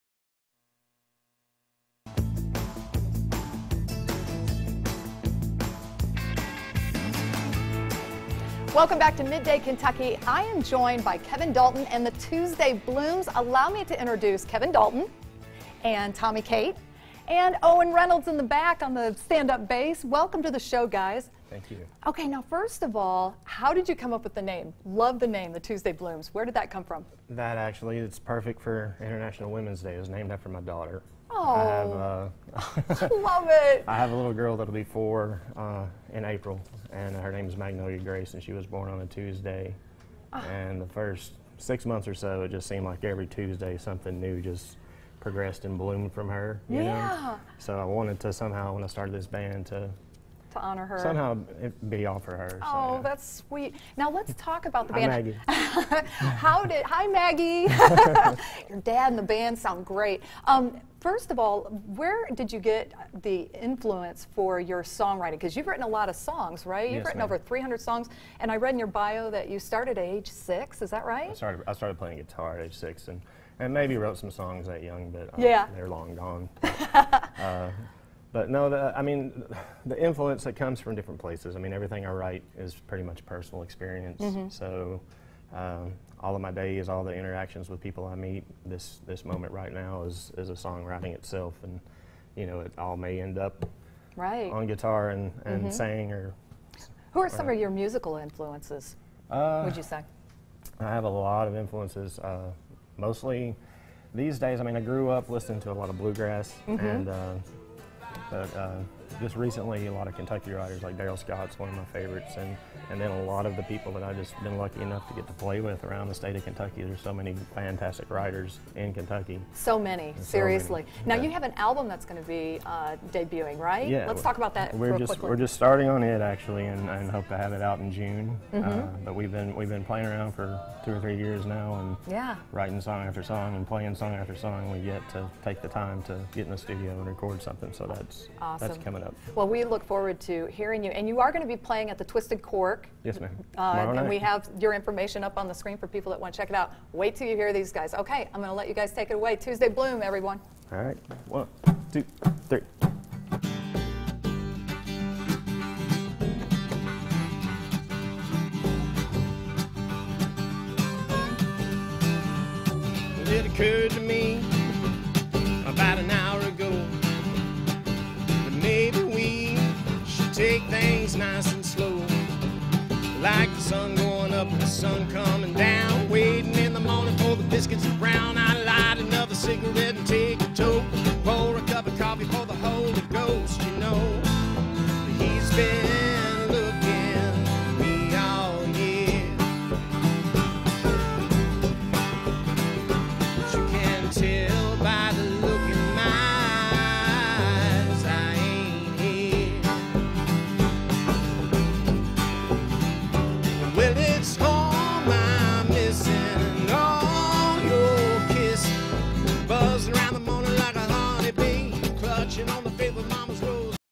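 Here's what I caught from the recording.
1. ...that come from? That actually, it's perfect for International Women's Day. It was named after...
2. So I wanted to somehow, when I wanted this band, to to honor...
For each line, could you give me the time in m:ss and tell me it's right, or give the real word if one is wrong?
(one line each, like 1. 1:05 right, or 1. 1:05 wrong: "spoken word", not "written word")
1. 0:26 right
2. 0:47 wrong: "started", not "wanted".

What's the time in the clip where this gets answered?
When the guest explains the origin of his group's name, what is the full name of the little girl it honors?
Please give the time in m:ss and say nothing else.
0:37.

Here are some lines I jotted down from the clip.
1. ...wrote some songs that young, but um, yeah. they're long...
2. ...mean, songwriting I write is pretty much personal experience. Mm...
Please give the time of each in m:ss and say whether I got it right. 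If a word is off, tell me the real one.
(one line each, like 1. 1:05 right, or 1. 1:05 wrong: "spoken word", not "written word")
1. 1:13 right
2. 1:21 wrong: "everything", not "songwriting".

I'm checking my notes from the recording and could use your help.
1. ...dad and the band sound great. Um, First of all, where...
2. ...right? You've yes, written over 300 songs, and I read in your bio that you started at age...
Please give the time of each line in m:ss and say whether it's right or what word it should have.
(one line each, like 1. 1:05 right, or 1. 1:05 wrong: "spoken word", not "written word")
1. 0:58 right
2. 1:06 right.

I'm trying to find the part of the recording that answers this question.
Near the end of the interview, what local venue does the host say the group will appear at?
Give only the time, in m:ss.
2:22.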